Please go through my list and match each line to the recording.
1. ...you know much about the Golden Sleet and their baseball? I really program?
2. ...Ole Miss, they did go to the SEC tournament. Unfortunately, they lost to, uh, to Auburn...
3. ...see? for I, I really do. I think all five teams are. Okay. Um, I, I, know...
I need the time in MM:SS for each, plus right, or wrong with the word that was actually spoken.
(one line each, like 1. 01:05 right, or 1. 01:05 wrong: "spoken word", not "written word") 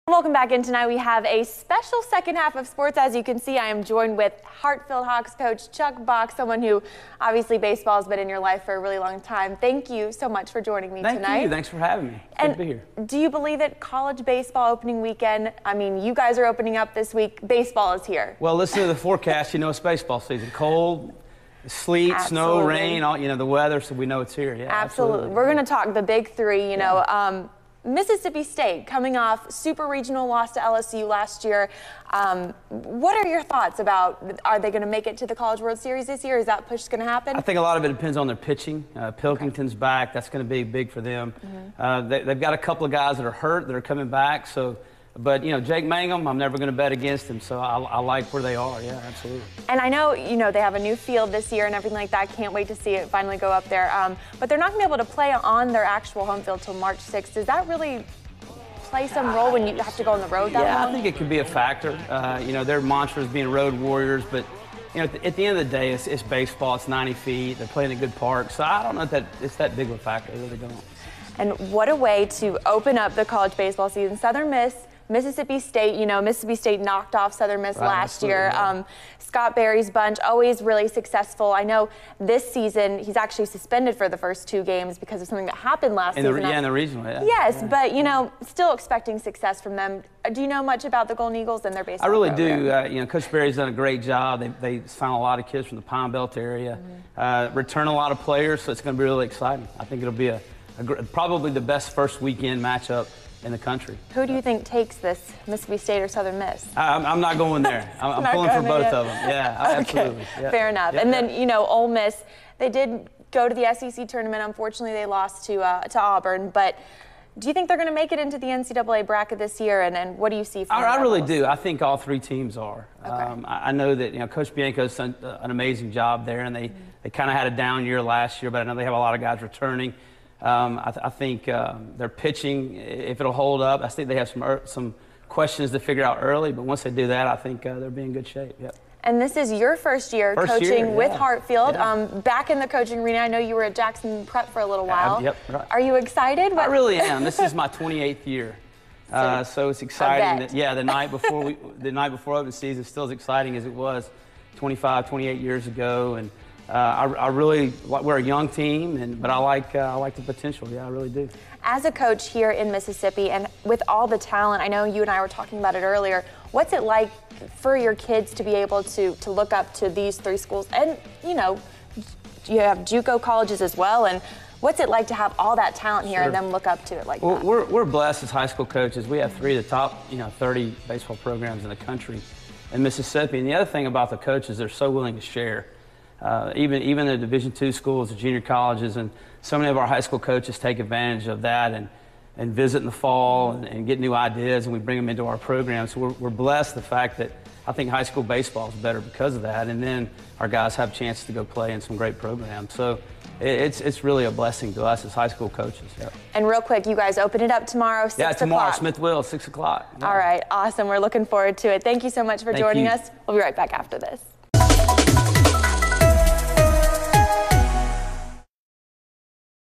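1. 01:30 wrong: "Eagles", not "Sleet"
2. 01:51 right
3. 02:00 wrong: "three", not "five".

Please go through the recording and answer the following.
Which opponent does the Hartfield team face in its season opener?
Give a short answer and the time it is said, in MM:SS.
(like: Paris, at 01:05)
Smithville, at 03:28.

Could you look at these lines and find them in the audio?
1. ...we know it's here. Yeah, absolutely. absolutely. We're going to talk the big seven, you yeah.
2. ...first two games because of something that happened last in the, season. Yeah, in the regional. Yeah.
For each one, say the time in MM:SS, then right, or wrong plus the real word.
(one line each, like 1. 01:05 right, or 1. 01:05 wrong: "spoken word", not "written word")
1. 00:23 wrong: "three", not "seven"
2. 01:24 right.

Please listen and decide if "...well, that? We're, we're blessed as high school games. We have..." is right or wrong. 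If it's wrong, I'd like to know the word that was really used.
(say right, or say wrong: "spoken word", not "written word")
wrong: "coaches", not "games".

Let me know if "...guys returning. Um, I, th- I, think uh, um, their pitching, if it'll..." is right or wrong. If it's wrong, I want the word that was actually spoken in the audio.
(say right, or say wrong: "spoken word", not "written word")
right.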